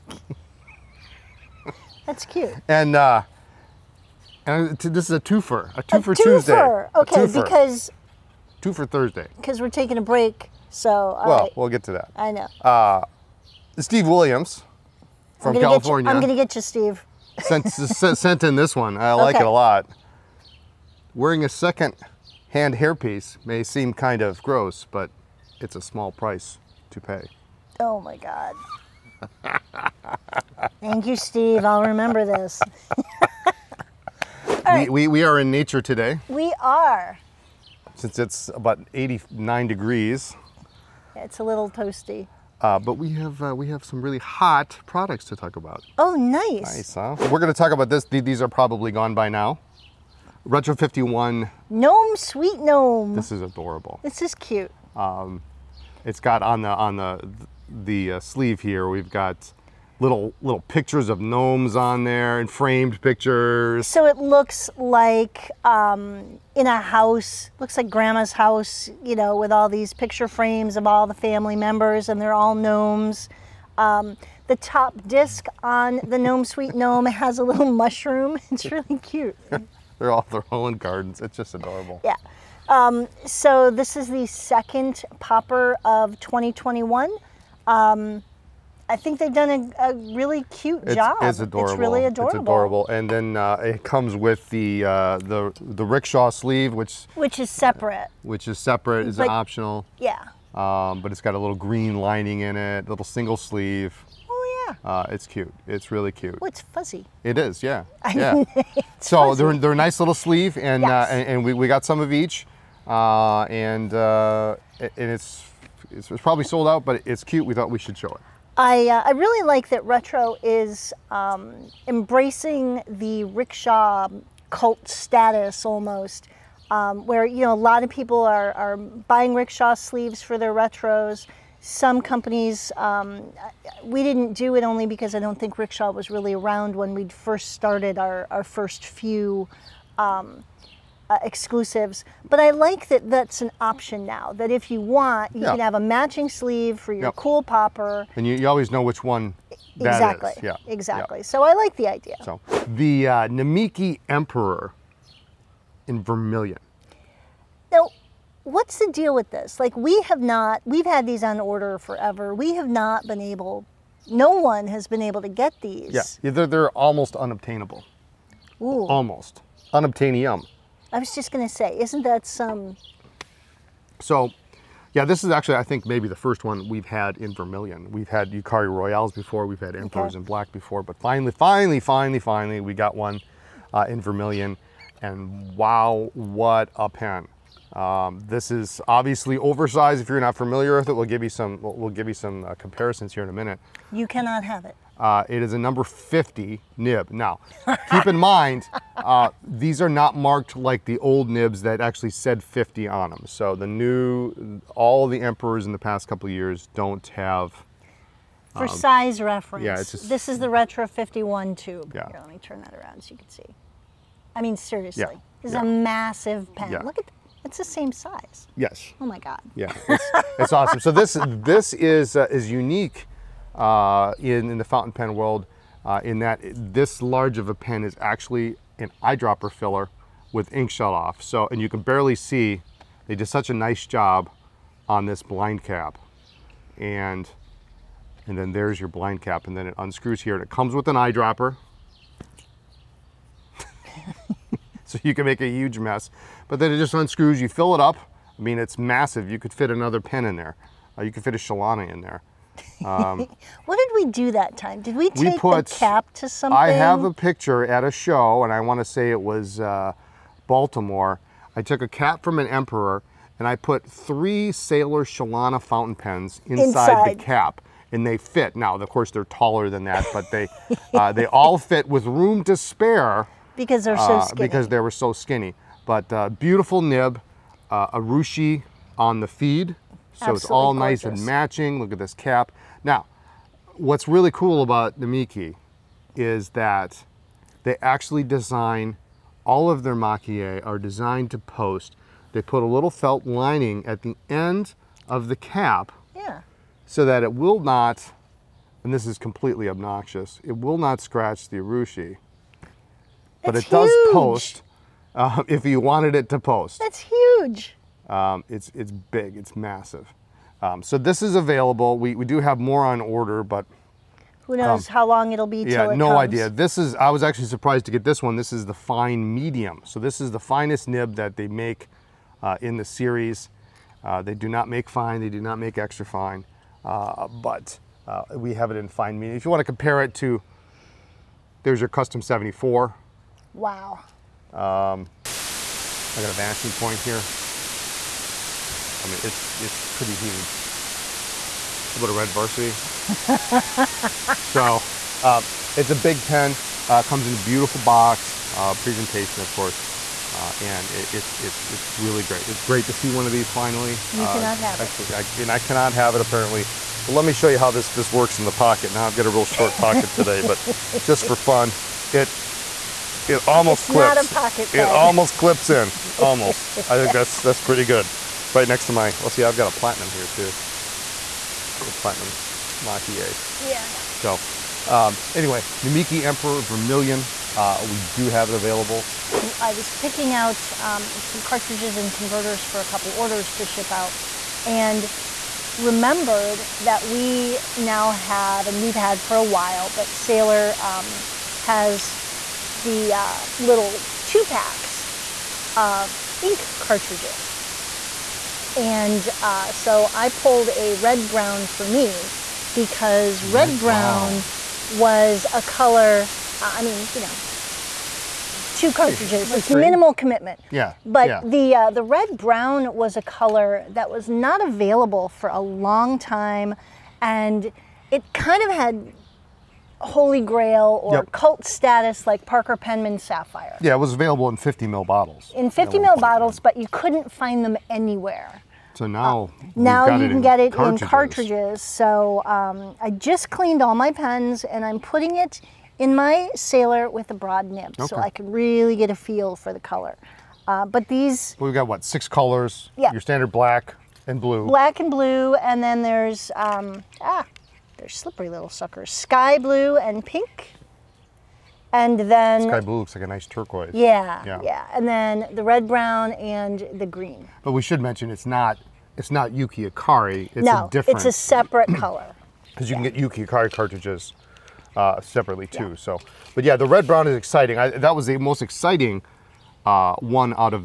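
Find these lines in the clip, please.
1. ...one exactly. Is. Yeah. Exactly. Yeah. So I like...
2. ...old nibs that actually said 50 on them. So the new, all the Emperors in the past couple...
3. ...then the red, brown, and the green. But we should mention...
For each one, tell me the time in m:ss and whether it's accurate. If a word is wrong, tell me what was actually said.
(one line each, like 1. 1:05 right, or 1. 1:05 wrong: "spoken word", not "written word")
1. 2:29 right
2. 3:20 right
3. 7:35 right.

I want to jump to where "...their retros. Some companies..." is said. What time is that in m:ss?
2:10.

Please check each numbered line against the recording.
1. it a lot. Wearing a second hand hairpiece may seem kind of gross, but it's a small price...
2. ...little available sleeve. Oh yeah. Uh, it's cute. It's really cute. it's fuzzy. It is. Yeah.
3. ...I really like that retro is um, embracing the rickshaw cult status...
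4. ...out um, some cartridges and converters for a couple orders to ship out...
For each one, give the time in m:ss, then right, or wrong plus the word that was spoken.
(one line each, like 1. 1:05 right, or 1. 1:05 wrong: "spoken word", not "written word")
1. 0:19 right
2. 1:42 wrong: "single", not "available"
3. 1:59 right
4. 6:20 right.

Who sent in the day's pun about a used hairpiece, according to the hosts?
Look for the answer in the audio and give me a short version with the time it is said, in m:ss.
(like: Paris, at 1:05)
Steve Williams, at 0:13.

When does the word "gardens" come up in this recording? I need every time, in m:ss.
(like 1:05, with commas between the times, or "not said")
1:20.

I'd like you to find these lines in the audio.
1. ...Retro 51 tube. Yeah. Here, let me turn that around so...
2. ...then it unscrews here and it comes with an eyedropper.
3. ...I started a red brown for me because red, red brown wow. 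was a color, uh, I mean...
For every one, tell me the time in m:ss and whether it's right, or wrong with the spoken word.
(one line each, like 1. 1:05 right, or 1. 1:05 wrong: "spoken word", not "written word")
1. 3:30 right
2. 3:59 right
3. 6:40 wrong: "pulled", not "started".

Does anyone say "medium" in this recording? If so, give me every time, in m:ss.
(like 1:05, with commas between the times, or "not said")
5:19, 5:29.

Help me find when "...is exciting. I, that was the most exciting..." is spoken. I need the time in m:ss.
7:47.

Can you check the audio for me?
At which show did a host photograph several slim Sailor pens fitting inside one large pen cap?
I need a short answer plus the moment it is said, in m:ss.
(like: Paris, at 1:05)
Baltimore, at 4:20.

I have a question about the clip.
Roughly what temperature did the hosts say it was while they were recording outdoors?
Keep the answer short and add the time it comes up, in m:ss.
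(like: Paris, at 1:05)
89 degrees, at 0:38.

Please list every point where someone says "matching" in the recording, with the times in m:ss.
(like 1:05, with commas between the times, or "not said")
2:25, 4:41.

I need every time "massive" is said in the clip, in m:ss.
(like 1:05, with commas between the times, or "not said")
3:35, 4:08, 5:09.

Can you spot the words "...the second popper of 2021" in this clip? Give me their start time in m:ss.
1:24.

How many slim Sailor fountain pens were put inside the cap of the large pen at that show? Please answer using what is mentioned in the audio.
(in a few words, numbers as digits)
3.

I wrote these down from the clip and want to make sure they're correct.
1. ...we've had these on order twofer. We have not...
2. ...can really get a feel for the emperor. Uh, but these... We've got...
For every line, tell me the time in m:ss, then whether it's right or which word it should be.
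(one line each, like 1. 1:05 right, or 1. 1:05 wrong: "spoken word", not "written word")
1. 2:40 wrong: "forever", not "twofer"
2. 7:18 wrong: "color", not "emperor".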